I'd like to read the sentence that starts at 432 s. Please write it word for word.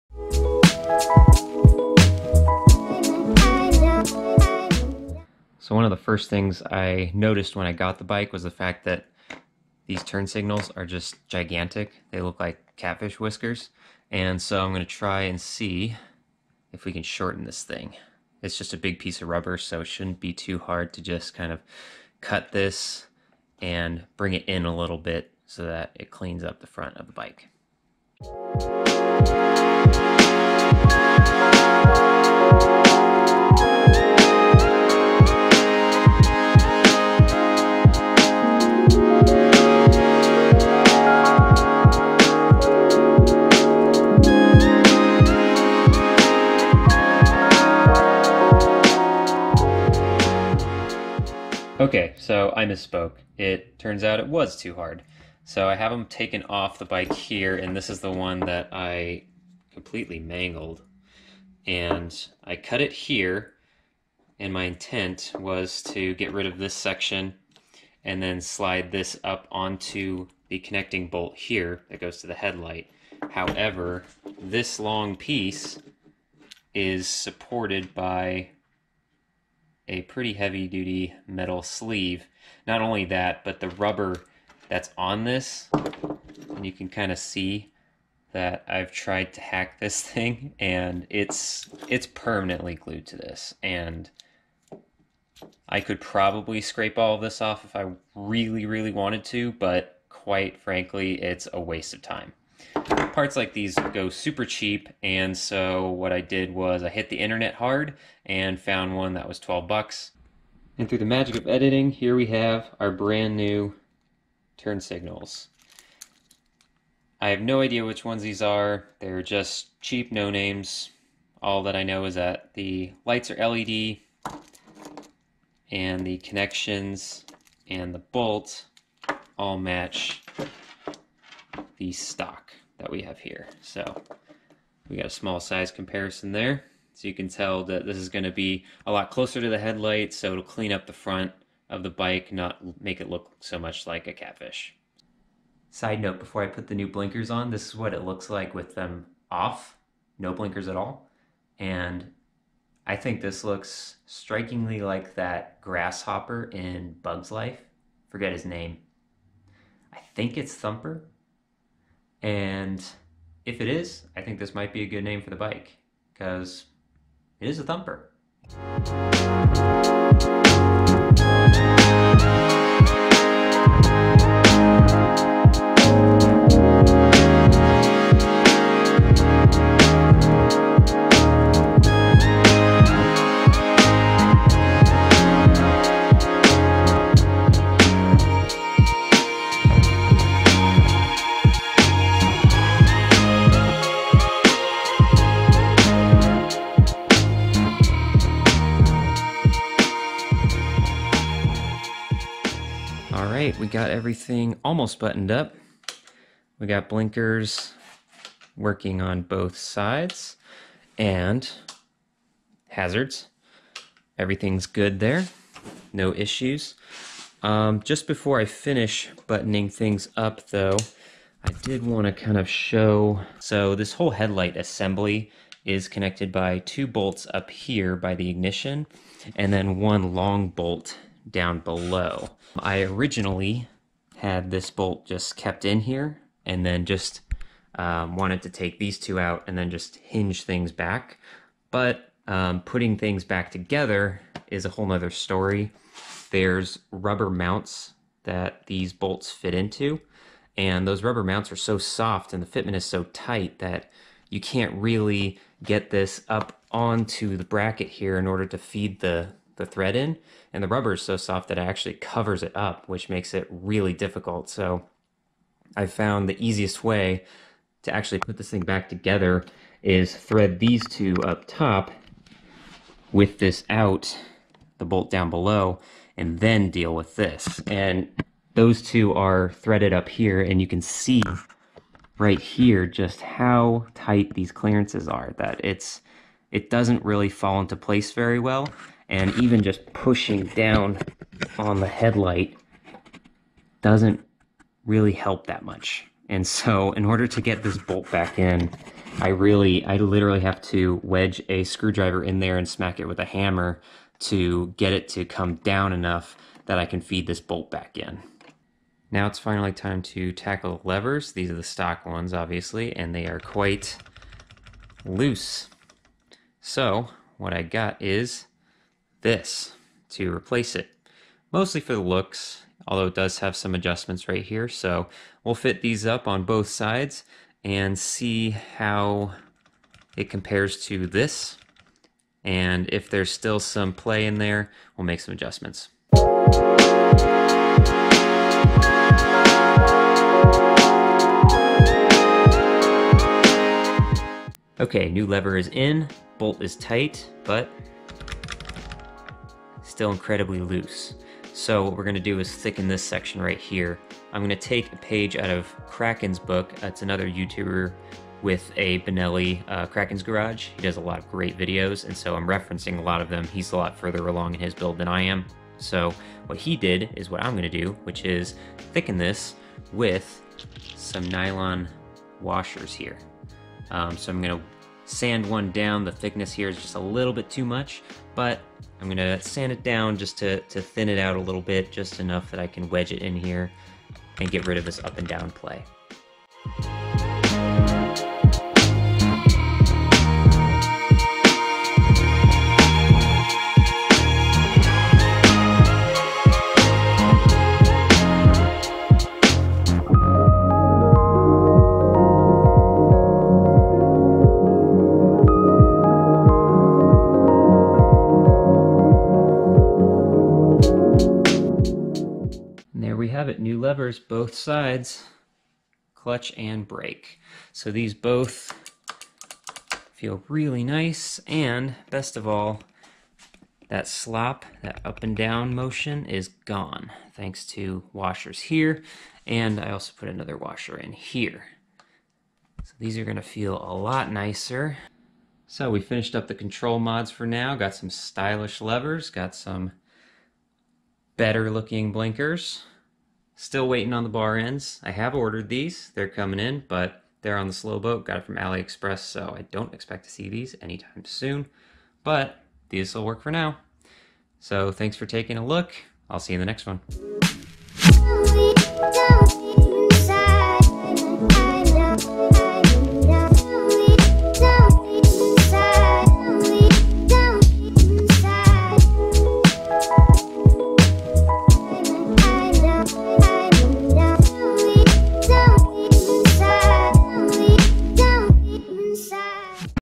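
So these are gonna feel a lot nicer.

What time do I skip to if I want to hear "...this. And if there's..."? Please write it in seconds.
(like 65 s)
331 s.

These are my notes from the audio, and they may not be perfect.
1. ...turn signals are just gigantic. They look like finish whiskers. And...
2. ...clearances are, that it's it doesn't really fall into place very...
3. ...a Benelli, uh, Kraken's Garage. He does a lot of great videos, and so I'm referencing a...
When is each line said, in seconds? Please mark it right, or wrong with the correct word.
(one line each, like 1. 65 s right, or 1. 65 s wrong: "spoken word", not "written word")
1. 10 s wrong: "catfish", not "finish"
2. 284 s right
3. 358 s right.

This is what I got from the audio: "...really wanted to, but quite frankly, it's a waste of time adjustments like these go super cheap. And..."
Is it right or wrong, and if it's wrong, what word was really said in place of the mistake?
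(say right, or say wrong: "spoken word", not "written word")
wrong: "parts", not "adjustments".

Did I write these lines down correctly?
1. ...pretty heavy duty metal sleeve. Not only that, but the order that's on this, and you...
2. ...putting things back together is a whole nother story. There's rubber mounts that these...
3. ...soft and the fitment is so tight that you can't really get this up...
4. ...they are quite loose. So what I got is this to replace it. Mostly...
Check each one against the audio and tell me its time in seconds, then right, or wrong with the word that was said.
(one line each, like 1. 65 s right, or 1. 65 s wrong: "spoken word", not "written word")
1. 80 s wrong: "rubber", not "order"
2. 242 s right
3. 251 s right
4. 313 s right.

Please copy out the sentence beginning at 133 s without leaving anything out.
So we got a small size comparison there.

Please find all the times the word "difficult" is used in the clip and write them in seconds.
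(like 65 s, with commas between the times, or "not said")
263 s.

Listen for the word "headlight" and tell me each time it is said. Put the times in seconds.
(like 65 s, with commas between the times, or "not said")
72 s, 139 s, 224 s, 291 s.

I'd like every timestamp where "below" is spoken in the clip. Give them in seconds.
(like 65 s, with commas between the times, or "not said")
231 s, 275 s.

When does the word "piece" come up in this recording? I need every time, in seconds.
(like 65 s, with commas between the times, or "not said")
18 s, 75 s.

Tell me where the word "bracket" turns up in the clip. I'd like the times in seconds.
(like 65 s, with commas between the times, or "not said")
257 s.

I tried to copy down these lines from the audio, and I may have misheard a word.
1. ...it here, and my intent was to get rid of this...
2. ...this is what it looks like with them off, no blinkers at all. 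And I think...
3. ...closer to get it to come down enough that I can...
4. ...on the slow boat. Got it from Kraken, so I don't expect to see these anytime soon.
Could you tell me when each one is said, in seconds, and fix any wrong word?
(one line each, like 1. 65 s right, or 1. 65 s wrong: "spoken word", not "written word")
1. 62 s right
2. 147 s right
3. 303 s wrong: "hammer", not "closer"
4. 447 s wrong: "AliExpress", not "Kraken".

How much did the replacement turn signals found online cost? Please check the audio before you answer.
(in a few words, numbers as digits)
$12.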